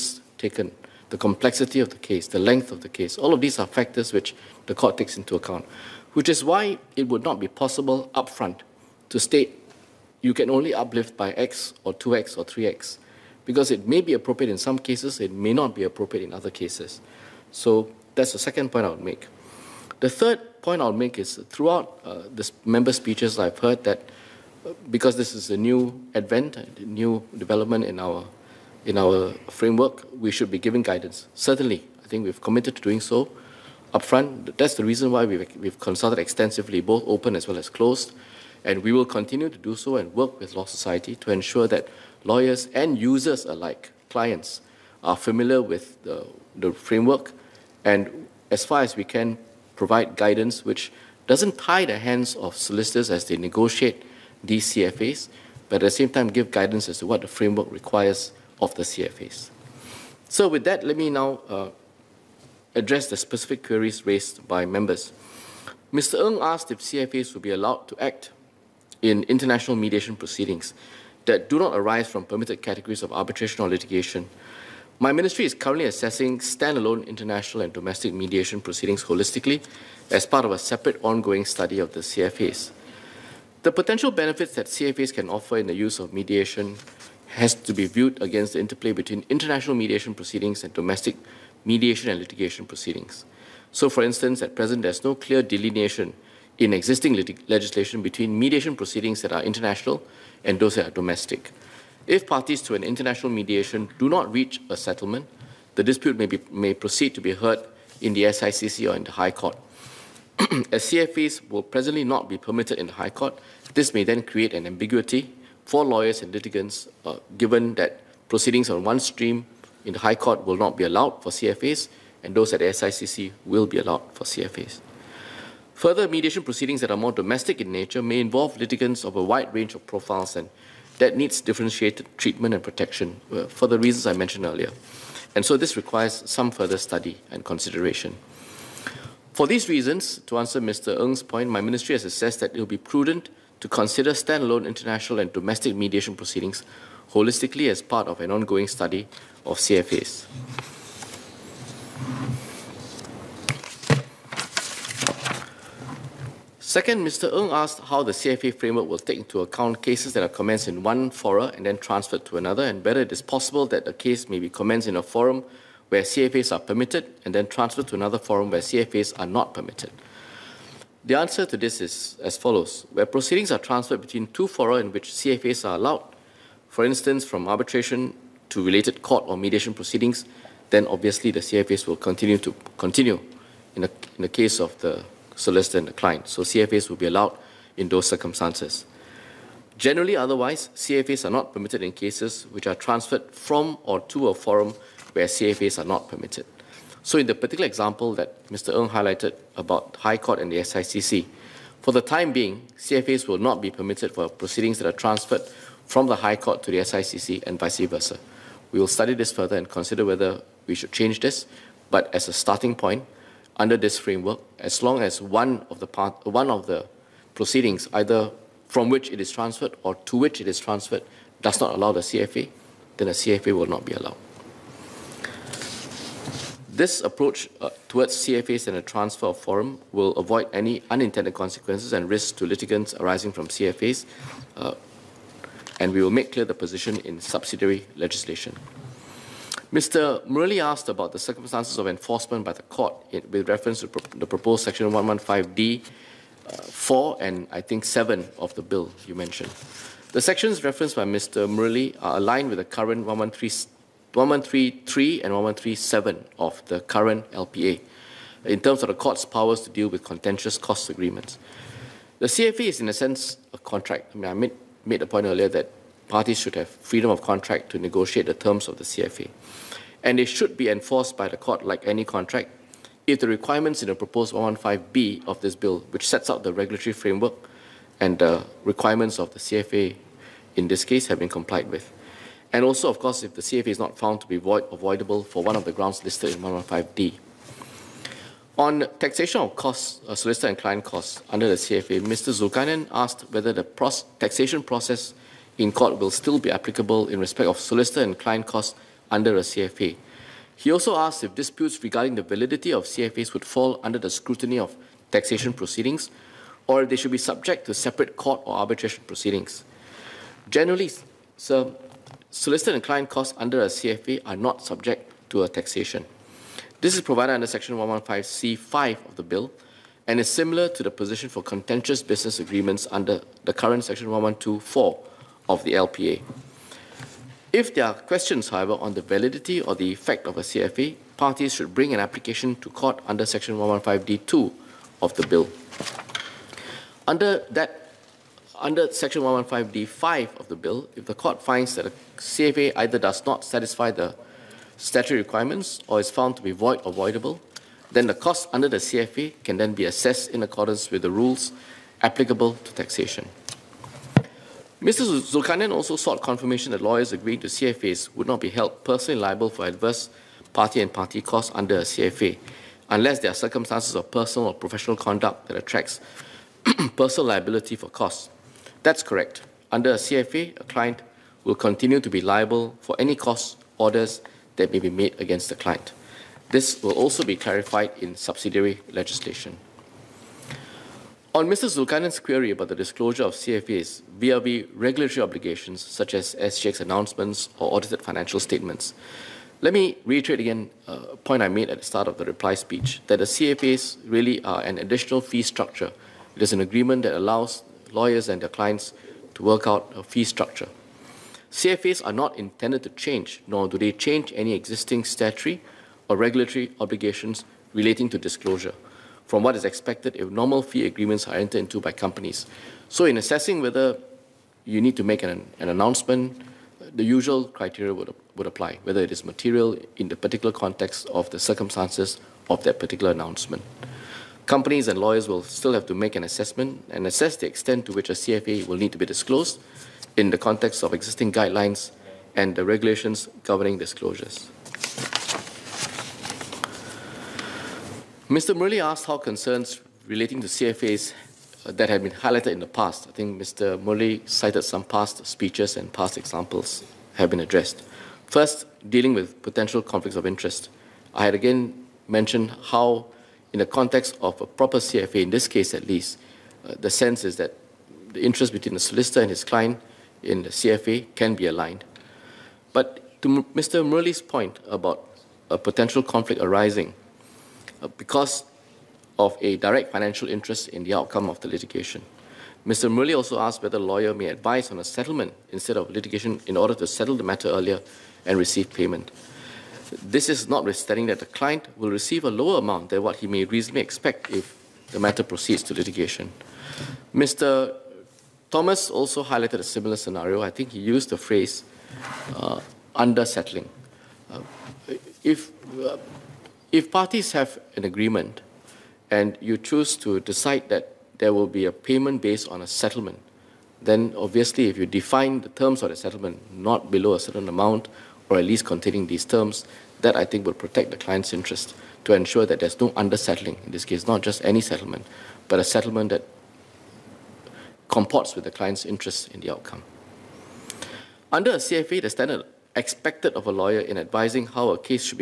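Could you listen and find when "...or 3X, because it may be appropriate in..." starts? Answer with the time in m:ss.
0:12.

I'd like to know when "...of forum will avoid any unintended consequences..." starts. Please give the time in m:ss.
3:49.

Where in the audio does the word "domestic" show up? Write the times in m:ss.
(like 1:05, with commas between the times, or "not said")
1:17, 1:30, 1:40, 2:07, 2:25.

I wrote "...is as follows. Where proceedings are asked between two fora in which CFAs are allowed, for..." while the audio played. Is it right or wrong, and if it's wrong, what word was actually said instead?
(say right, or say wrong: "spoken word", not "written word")
wrong: "transferred", not "asked".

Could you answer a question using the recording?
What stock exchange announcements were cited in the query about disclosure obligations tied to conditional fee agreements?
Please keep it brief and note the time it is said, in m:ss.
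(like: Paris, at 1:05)
SGX announcements, at 6:26.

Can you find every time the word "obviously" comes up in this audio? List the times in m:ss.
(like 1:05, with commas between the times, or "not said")
3:00, 8:24.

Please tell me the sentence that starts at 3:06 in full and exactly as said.
So CFAs will be allowed in those circumstances.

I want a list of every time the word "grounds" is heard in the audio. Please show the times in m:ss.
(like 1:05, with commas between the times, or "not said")
4:45.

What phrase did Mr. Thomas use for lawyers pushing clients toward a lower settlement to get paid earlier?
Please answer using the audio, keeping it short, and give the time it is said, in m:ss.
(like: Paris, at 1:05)
under settling, at 8:12.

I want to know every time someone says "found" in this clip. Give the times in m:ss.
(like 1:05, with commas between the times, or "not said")
4:43, 5:46.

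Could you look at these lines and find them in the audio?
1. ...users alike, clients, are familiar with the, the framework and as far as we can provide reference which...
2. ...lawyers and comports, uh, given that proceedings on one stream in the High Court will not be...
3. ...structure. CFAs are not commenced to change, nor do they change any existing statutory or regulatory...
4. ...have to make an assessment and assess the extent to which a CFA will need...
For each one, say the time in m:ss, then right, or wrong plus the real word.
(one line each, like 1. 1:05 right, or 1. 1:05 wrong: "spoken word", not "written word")
1. 0:42 wrong: "guidance", not "reference"
2. 1:55 wrong: "litigants", not "comports"
3. 6:40 wrong: "intended", not "commenced"
4. 7:05 right.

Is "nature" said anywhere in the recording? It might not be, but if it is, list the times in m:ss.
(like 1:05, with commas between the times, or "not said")
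2:07.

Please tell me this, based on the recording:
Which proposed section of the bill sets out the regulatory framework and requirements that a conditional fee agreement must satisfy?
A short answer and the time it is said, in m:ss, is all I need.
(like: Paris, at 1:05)
115B, at 4:34.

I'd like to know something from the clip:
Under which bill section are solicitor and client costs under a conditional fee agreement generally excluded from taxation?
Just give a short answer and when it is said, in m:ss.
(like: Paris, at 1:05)
Section 115C5, at 5:17.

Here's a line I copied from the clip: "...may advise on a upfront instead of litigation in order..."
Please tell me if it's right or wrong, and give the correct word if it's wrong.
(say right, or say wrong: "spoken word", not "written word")
wrong: "settlement", not "upfront".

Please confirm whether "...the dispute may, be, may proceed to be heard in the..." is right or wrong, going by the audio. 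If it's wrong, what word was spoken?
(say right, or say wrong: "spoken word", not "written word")
right.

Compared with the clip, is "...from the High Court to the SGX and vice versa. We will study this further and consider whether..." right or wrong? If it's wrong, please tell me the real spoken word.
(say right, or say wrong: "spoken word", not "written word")
wrong: "SICC", not "SGX".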